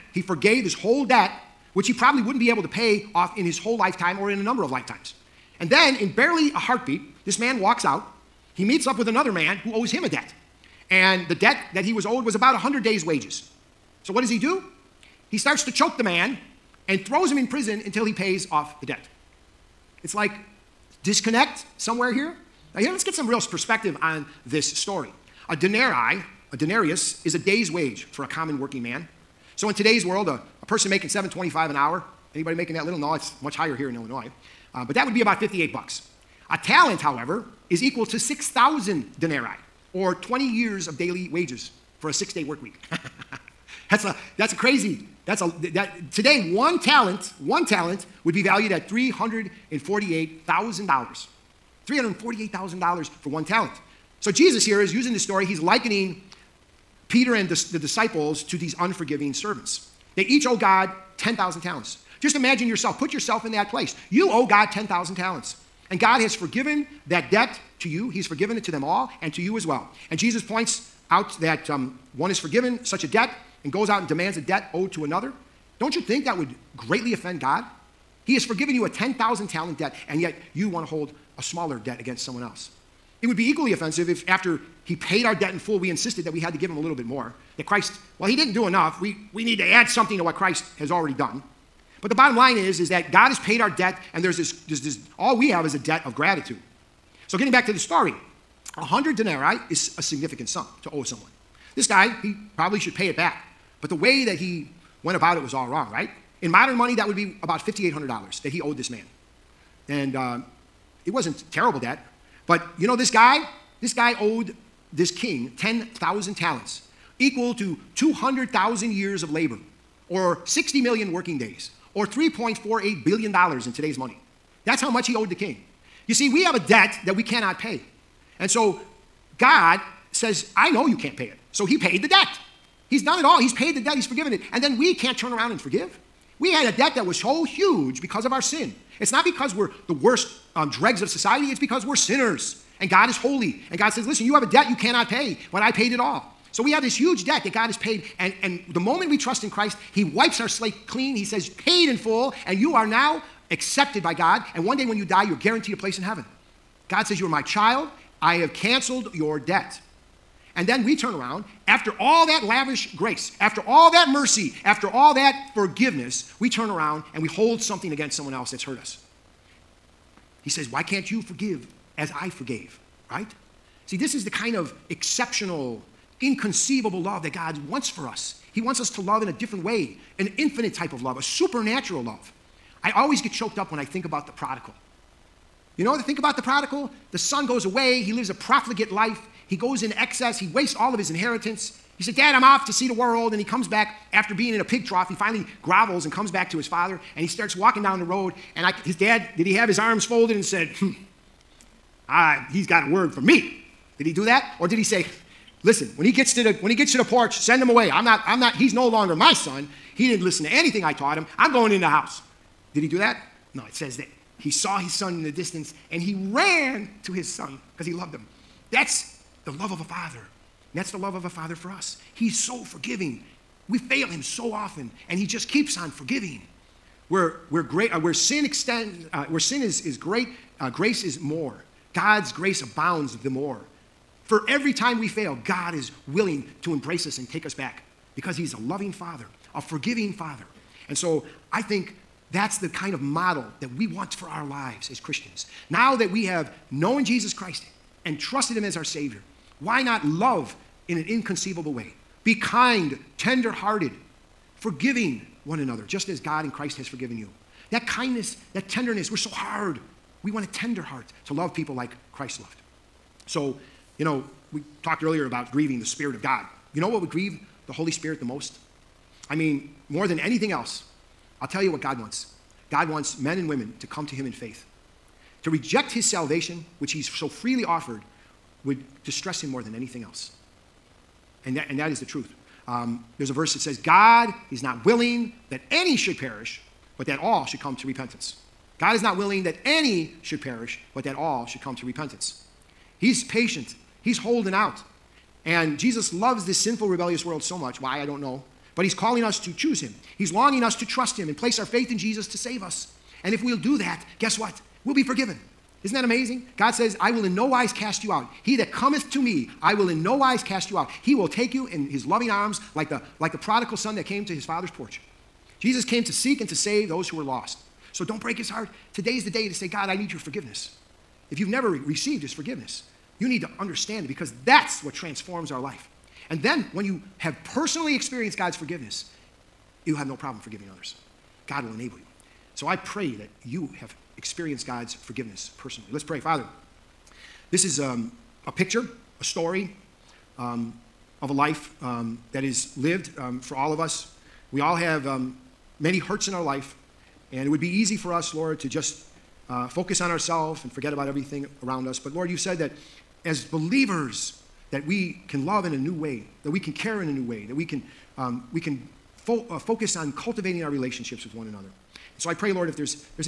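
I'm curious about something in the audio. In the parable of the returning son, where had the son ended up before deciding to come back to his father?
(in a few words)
pig trough.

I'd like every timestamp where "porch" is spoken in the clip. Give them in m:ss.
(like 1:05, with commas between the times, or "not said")
3:27, 5:14.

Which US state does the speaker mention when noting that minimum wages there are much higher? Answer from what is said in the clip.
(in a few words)
Illinois.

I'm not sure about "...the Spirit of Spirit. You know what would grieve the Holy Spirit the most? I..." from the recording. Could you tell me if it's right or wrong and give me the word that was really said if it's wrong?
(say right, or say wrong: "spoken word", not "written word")
wrong: "God", not "Spirit".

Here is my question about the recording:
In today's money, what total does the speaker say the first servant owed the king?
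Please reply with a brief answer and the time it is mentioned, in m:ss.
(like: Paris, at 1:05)
$3.48 billion, at 2:02.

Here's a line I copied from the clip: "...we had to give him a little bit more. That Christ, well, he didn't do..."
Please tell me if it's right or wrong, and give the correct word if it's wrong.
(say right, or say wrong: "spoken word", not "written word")
right.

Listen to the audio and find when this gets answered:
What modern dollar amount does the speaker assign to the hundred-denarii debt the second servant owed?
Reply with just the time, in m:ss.
1:47.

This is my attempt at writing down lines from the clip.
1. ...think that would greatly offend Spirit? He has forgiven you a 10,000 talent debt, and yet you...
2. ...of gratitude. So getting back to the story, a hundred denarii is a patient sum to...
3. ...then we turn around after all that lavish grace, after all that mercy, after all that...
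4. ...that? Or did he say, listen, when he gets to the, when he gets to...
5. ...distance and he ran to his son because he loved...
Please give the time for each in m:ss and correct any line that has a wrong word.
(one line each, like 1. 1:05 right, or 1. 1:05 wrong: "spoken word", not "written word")
1. 1:15 wrong: "God", not "Spirit"
2. 1:36 wrong: "significant", not "patient"
3. 2:40 right
4. 3:24 right
5. 3:35 right.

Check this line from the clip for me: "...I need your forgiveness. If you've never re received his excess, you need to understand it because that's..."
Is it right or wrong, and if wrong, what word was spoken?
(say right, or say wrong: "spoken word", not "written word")
wrong: "forgiveness", not "excess".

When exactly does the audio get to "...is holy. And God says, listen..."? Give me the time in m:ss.
2:23.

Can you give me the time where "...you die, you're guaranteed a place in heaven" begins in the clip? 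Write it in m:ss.
2:34.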